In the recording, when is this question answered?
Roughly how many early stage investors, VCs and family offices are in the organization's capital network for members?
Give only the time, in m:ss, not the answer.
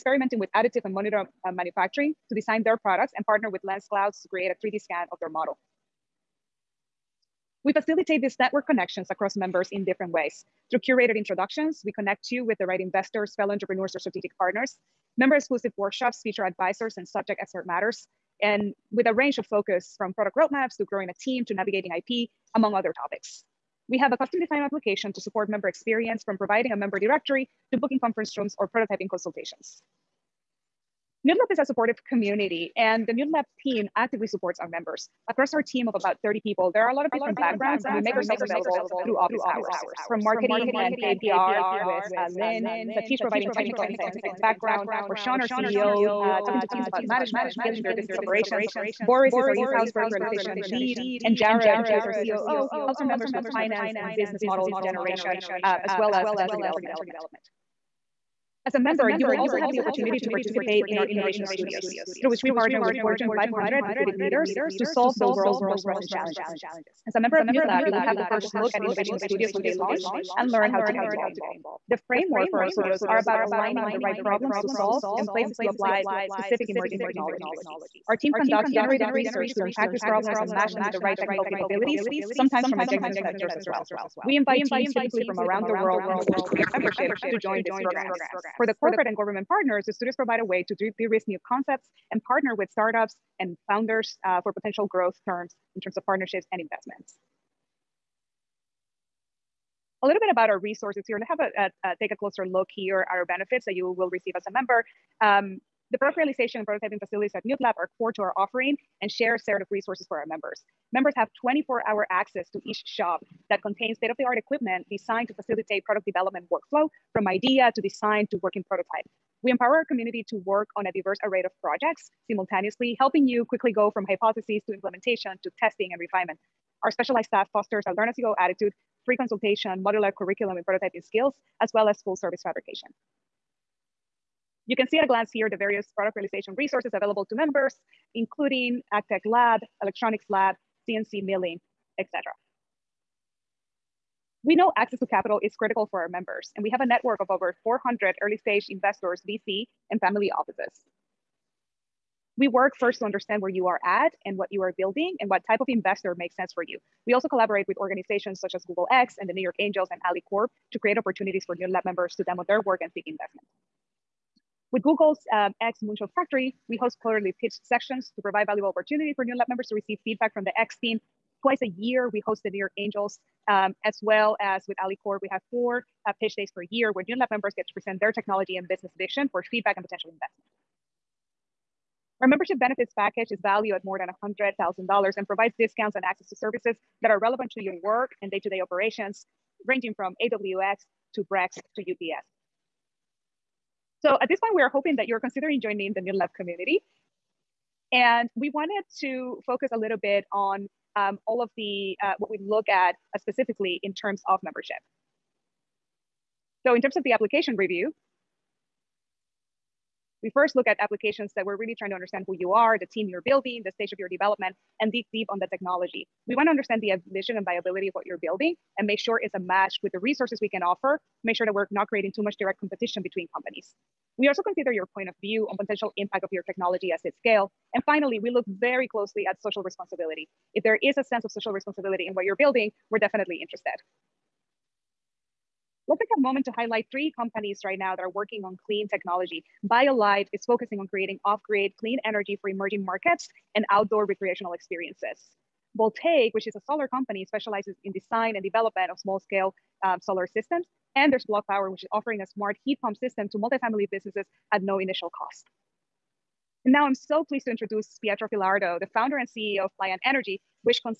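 2:27.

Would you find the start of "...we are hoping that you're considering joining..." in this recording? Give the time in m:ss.
3:14.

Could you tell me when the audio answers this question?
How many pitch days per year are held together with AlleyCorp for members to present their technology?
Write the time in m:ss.
2:55.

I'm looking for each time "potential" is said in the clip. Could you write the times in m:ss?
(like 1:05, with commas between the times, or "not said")
1:34, 2:59, 3:45.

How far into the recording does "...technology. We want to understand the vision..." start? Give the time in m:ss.
3:35.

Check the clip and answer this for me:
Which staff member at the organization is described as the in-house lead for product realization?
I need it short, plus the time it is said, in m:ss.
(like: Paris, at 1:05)
Boris, at 0:49.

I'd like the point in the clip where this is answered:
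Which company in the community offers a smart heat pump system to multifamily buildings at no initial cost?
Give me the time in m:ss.
4:11.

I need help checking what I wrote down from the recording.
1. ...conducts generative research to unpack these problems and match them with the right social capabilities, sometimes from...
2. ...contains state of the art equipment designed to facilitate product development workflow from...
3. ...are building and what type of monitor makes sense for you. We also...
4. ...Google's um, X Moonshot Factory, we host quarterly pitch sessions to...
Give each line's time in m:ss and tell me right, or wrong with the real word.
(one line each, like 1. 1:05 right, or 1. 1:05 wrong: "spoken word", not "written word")
1. 1:18 wrong: "technical", not "social"
2. 1:53 right
3. 2:34 wrong: "investor", not "monitor"
4. 2:44 right.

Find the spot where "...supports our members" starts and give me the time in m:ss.
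0:34.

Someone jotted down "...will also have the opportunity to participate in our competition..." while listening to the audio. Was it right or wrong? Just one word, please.
wrong.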